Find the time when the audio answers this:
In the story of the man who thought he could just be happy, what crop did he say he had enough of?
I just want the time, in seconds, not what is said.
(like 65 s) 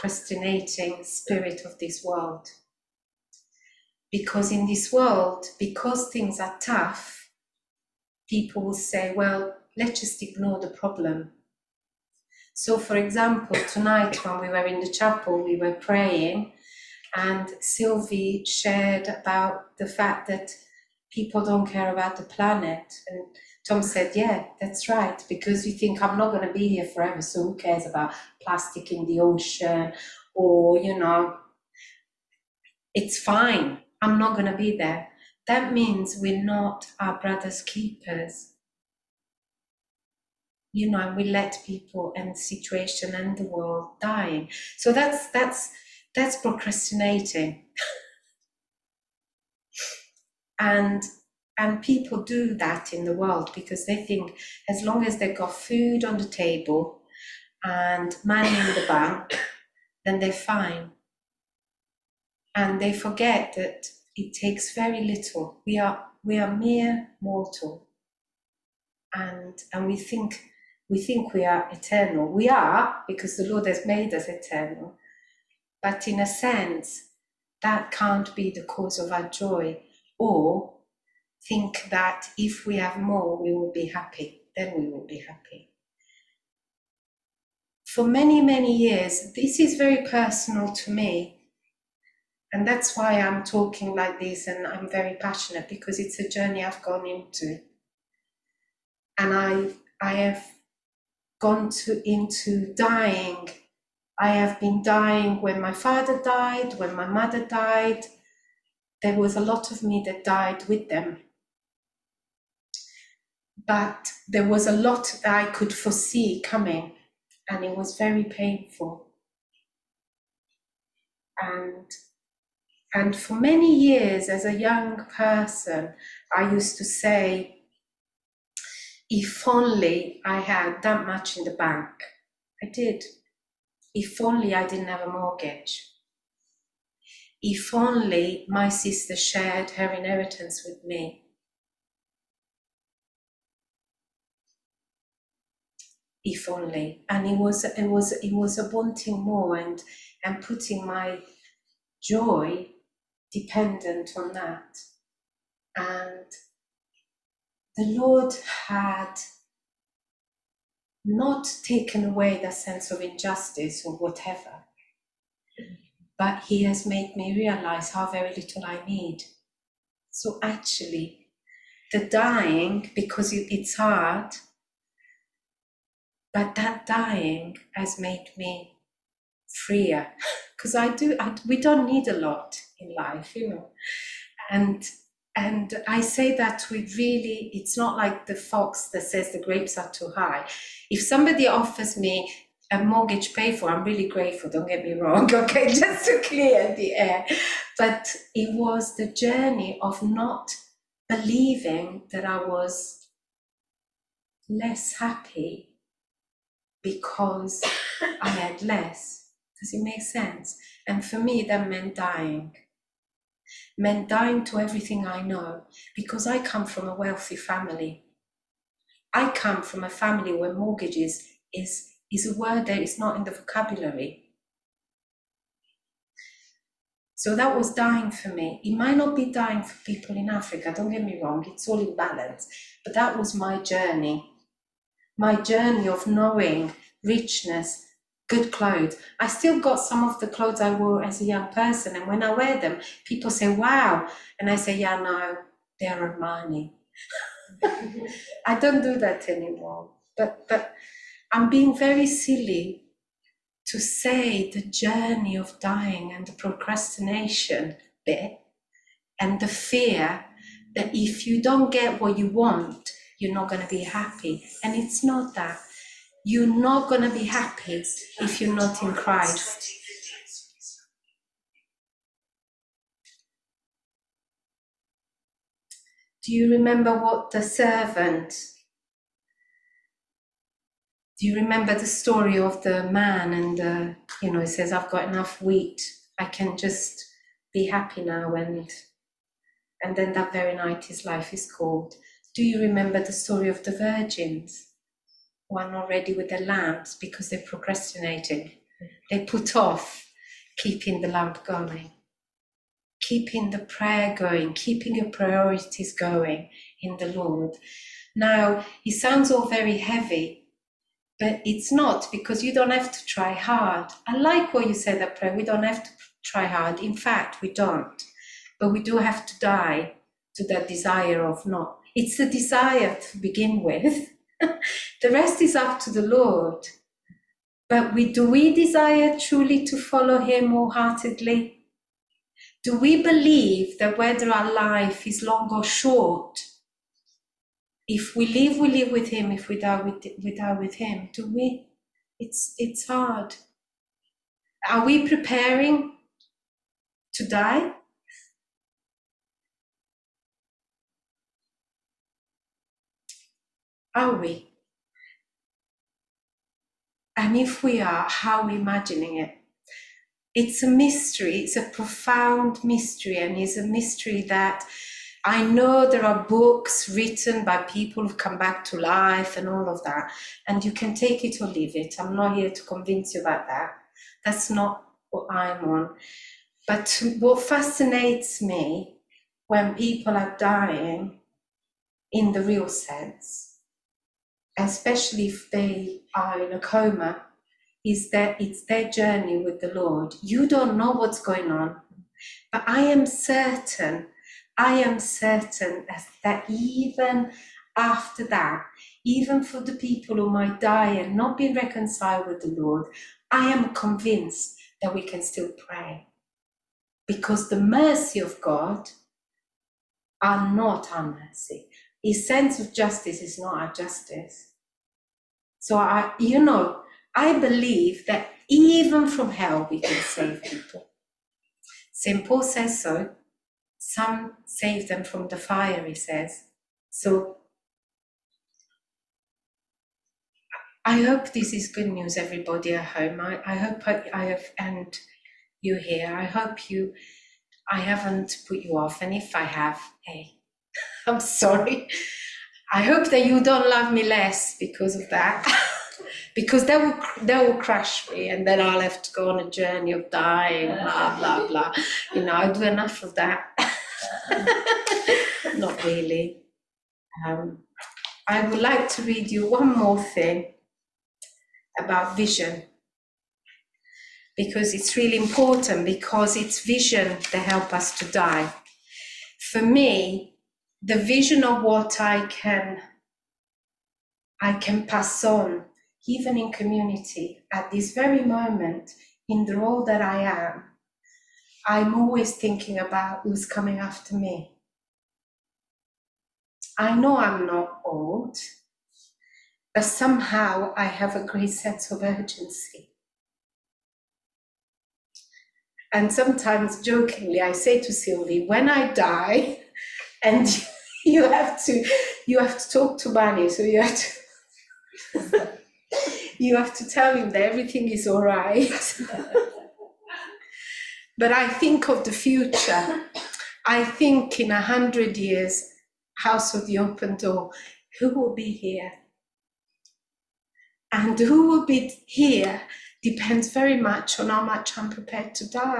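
285 s.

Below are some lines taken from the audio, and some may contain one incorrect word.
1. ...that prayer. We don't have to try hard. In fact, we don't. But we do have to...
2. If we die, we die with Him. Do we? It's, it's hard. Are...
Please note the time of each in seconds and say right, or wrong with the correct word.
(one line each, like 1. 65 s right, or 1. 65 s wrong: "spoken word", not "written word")
1. 315 s right
2. 339 s right.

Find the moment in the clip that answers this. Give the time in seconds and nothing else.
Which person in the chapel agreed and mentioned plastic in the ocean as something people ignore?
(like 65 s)
23 s.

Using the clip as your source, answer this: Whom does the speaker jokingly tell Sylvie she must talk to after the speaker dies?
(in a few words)
Bani.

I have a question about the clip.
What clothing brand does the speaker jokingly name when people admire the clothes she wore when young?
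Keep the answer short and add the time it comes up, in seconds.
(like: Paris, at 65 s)
Armani, at 246 s.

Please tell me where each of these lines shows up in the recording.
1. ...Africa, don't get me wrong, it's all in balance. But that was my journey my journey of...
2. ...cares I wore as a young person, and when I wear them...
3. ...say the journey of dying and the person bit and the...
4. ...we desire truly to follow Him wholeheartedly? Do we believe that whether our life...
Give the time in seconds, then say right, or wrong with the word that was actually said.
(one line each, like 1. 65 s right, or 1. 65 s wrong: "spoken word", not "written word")
1. 230 s right
2. 240 s wrong: "clothes", not "cares"
3. 253 s wrong: "procrastination", not "person"
4. 328 s right.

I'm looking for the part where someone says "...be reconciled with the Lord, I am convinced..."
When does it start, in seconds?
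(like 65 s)
401 s.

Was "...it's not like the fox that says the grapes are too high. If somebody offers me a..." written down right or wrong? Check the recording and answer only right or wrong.
right.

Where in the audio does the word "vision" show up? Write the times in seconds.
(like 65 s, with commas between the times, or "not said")
462 s, 466 s, 470 s.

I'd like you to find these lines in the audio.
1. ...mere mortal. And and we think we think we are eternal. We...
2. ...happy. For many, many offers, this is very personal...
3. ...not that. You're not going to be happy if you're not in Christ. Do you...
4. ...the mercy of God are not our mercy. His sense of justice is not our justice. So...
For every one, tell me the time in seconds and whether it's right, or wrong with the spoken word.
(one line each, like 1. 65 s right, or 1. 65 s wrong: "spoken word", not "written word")
1. 66 s right
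2. 85 s wrong: "years", not "offers"
3. 265 s right
4. 407 s right.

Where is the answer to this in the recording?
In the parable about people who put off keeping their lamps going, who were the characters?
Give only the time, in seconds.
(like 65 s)
293 s.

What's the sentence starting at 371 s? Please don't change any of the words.
I'm not here to convince you about that.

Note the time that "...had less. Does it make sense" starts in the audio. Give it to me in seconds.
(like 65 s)
208 s.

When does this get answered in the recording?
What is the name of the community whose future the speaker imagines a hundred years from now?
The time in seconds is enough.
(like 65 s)
516 s.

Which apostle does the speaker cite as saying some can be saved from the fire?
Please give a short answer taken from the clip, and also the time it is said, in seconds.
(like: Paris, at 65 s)
St. Paul, at 421 s.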